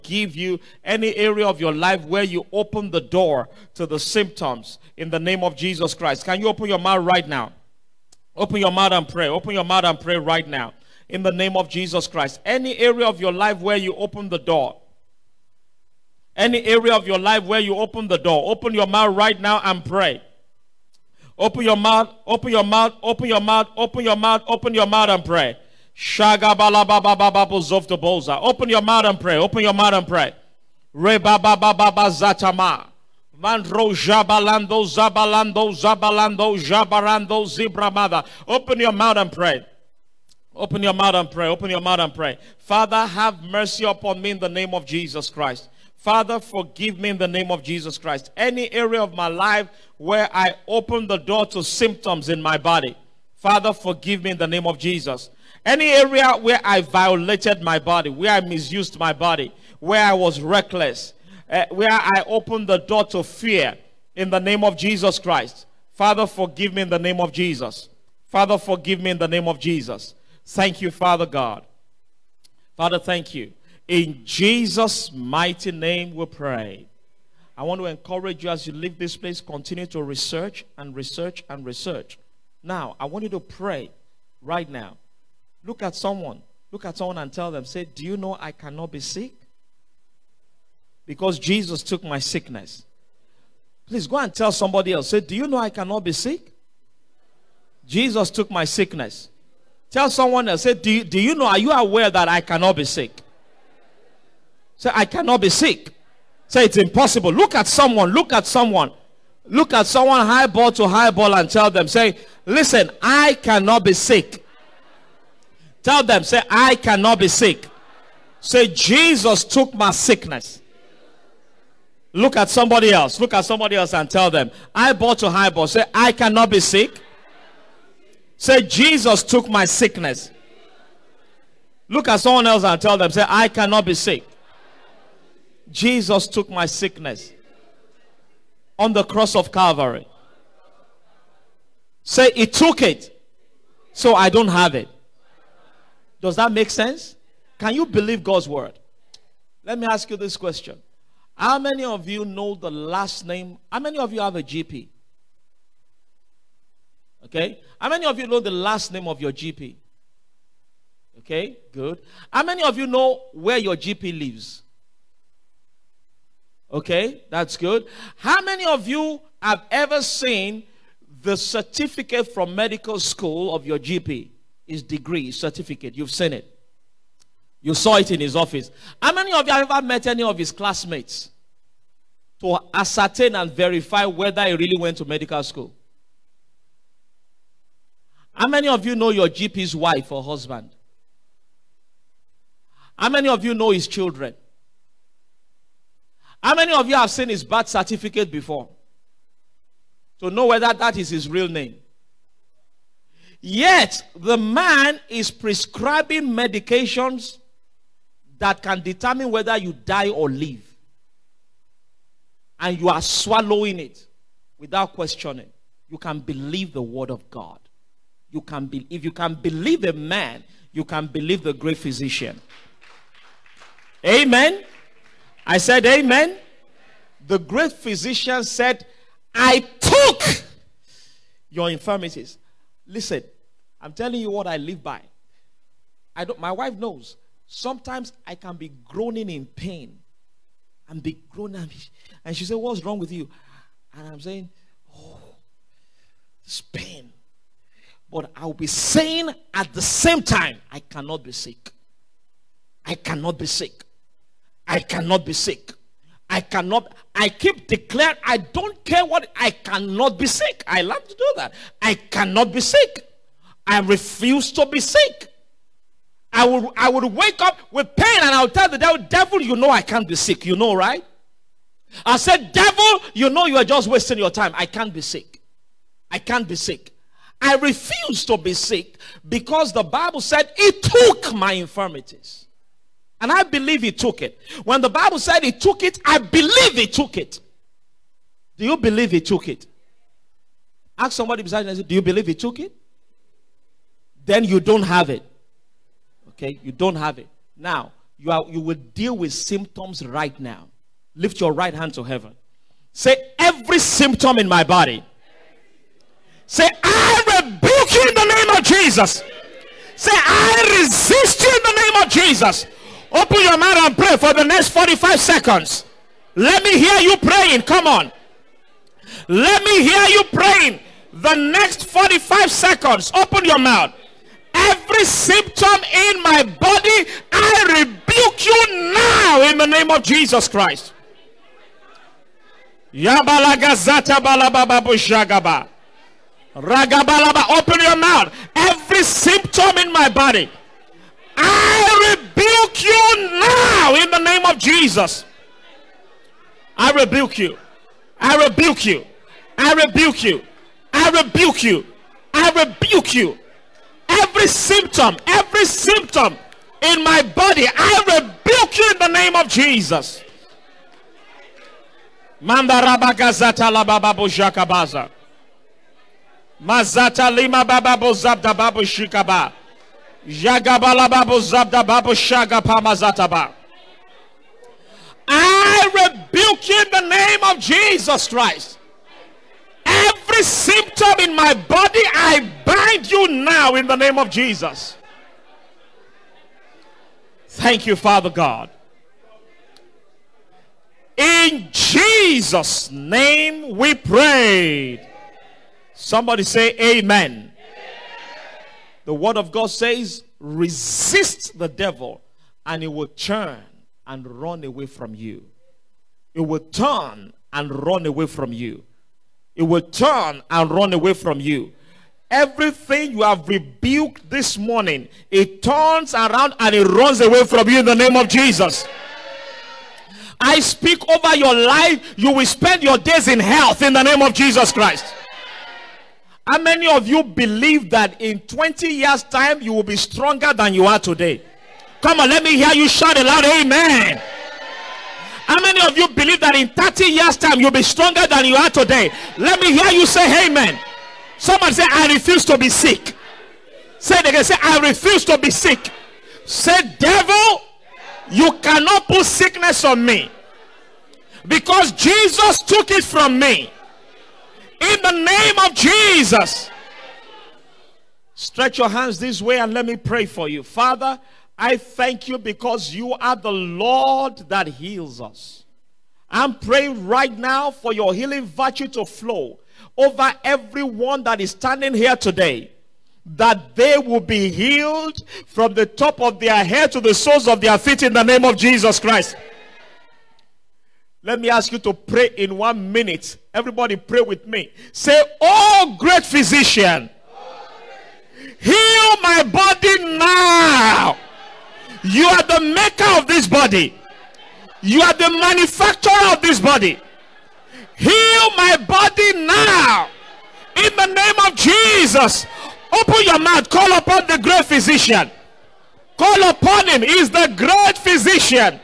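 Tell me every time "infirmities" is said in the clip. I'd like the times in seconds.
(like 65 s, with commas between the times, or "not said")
231 s, 281 s.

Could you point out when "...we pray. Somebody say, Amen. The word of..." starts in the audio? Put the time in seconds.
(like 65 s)
393 s.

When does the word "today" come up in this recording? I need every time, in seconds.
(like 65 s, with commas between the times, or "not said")
430 s, 438 s, 472 s.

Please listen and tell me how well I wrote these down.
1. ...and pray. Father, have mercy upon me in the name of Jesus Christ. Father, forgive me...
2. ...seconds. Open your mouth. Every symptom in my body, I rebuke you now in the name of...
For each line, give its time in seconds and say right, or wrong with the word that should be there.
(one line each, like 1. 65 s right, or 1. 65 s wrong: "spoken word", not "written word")
1. 41 s right
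2. 322 s right.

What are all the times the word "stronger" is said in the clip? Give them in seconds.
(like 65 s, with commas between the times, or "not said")
429 s, 437 s.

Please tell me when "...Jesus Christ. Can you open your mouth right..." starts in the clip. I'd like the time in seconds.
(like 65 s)
5 s.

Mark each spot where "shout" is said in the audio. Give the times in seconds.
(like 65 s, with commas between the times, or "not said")
432 s.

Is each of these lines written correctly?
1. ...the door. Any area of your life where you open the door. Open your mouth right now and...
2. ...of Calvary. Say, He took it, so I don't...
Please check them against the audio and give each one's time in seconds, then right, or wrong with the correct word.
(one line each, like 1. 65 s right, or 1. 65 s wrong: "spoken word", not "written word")
1. 14 s right
2. 139 s right.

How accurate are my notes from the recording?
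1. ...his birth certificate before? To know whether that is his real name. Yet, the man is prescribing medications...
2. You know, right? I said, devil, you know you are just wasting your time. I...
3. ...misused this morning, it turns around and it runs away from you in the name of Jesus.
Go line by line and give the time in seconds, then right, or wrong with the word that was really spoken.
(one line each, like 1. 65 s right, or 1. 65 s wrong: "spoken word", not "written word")
1. 197 s right
2. 270 s right
3. 413 s wrong: "rebuked", not "misused".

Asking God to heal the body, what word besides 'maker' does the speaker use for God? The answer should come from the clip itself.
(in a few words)
Manufacturer.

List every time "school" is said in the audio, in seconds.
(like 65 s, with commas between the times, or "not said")
172 s, 185 s.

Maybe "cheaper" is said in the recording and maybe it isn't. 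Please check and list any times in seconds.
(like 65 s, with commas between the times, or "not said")
not said.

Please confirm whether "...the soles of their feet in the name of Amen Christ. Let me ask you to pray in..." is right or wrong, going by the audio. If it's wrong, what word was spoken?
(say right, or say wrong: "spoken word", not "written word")
wrong: "Jesus", not "Amen".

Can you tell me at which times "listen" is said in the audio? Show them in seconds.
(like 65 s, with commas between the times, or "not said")
112 s, 232 s.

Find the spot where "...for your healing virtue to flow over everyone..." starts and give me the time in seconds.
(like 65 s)
467 s.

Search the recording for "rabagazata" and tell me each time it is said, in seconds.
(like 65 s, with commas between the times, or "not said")
362 s.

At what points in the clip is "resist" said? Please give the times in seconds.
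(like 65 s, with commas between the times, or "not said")
310 s, 400 s.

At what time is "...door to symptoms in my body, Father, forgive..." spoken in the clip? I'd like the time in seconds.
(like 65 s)
51 s.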